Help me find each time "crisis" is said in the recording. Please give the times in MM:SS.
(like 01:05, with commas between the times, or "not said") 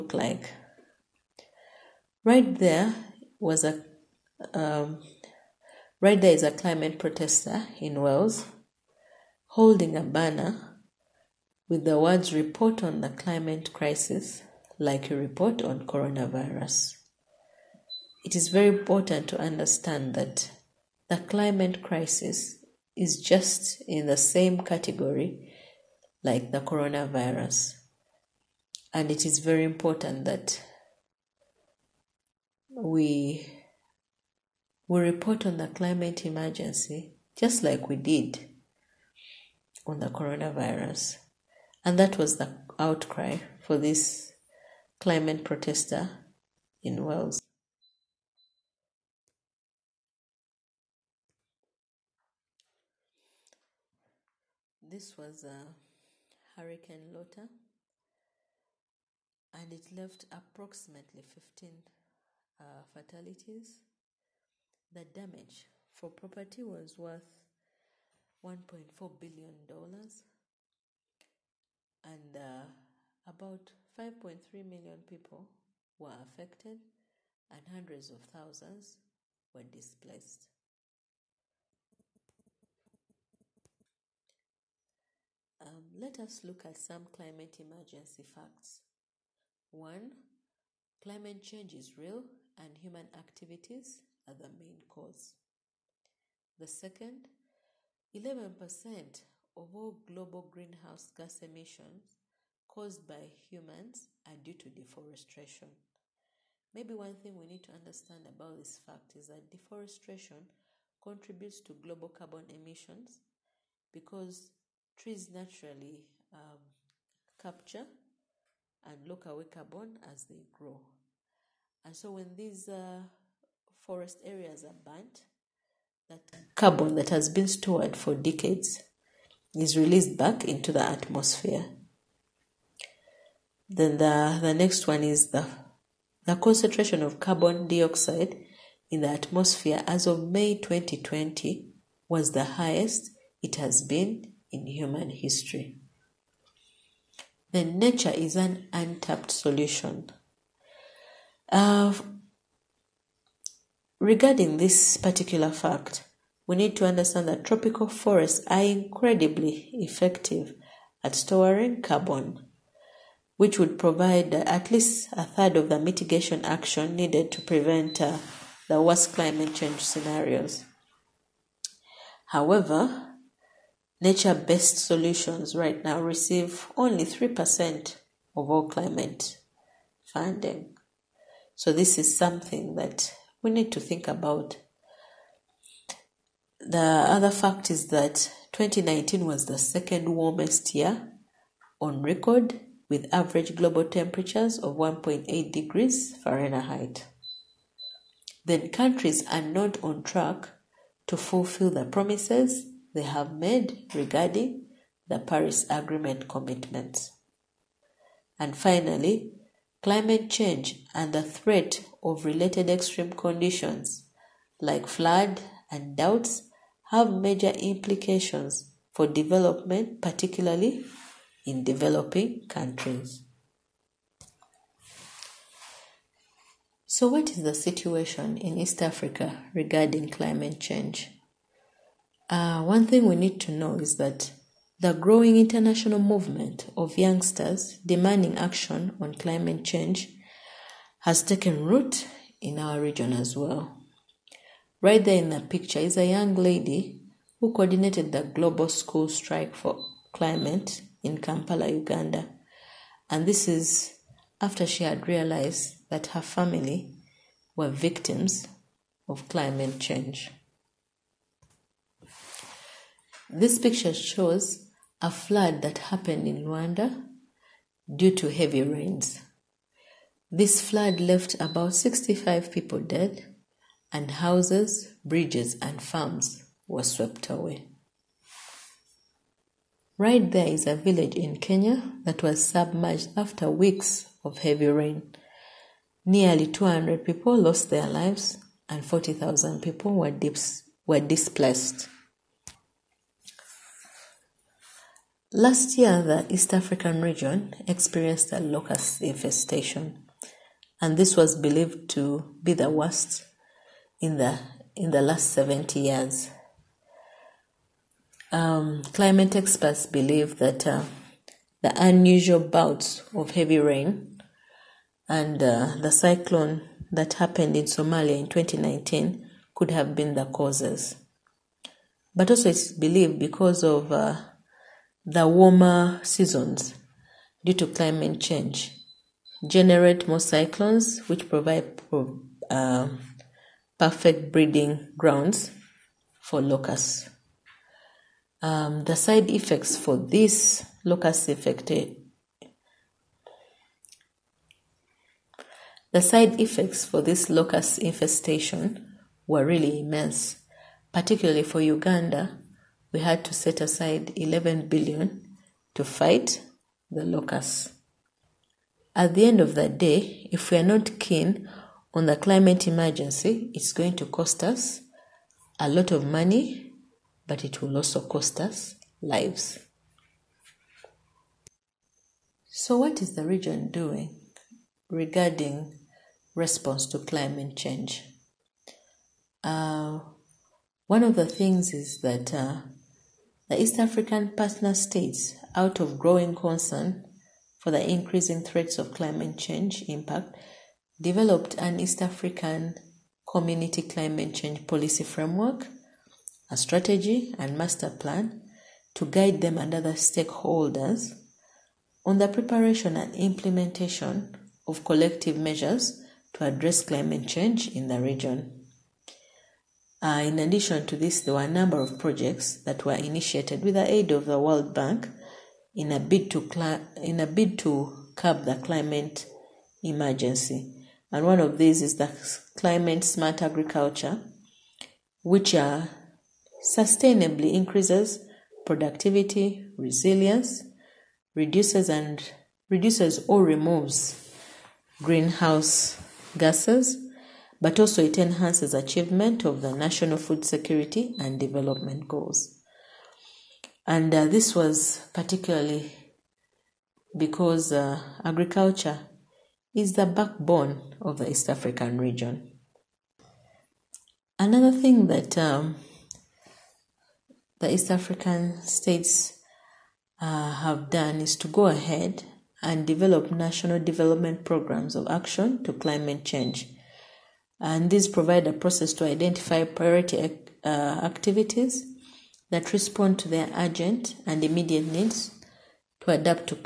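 00:13, 00:21.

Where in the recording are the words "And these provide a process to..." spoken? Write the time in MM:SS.
07:47.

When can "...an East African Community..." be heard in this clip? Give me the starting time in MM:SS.
06:31.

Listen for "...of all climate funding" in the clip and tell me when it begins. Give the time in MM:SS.
02:58.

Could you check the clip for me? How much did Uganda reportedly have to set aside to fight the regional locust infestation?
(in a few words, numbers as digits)
11 billion.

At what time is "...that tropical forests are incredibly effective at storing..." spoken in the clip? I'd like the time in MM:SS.
02:37.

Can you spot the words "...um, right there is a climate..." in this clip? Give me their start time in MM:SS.
00:04.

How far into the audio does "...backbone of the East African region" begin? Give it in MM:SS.
07:30.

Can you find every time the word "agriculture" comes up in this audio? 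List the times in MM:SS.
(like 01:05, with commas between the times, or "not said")
07:03, 07:28.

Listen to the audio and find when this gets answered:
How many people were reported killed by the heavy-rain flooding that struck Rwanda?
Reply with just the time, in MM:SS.
04:31.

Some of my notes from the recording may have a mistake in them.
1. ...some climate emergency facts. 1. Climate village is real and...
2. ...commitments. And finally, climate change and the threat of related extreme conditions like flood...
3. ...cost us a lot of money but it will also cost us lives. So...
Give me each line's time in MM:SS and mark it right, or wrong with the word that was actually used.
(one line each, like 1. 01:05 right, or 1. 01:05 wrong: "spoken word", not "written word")
1. 01:26 wrong: "change", not "village"
2. 03:26 right
3. 06:04 right.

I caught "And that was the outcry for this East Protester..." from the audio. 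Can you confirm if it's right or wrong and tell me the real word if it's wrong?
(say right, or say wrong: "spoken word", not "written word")
wrong: "Clement", not "East".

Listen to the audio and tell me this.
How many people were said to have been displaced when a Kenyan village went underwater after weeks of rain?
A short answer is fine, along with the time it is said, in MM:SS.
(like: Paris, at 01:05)
40,000, at 04:48.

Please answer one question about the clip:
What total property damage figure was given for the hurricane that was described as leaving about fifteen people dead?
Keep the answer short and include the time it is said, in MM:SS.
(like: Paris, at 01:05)
$1.4 billion, at 01:08.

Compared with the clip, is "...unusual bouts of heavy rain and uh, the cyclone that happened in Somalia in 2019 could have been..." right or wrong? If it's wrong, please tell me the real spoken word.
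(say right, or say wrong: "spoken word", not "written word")
right.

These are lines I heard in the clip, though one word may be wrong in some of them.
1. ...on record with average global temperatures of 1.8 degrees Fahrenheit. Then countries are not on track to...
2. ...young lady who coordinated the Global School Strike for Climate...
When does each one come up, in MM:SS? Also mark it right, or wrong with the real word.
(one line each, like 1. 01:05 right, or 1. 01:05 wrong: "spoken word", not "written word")
1. 03:11 right
2. 04:06 right.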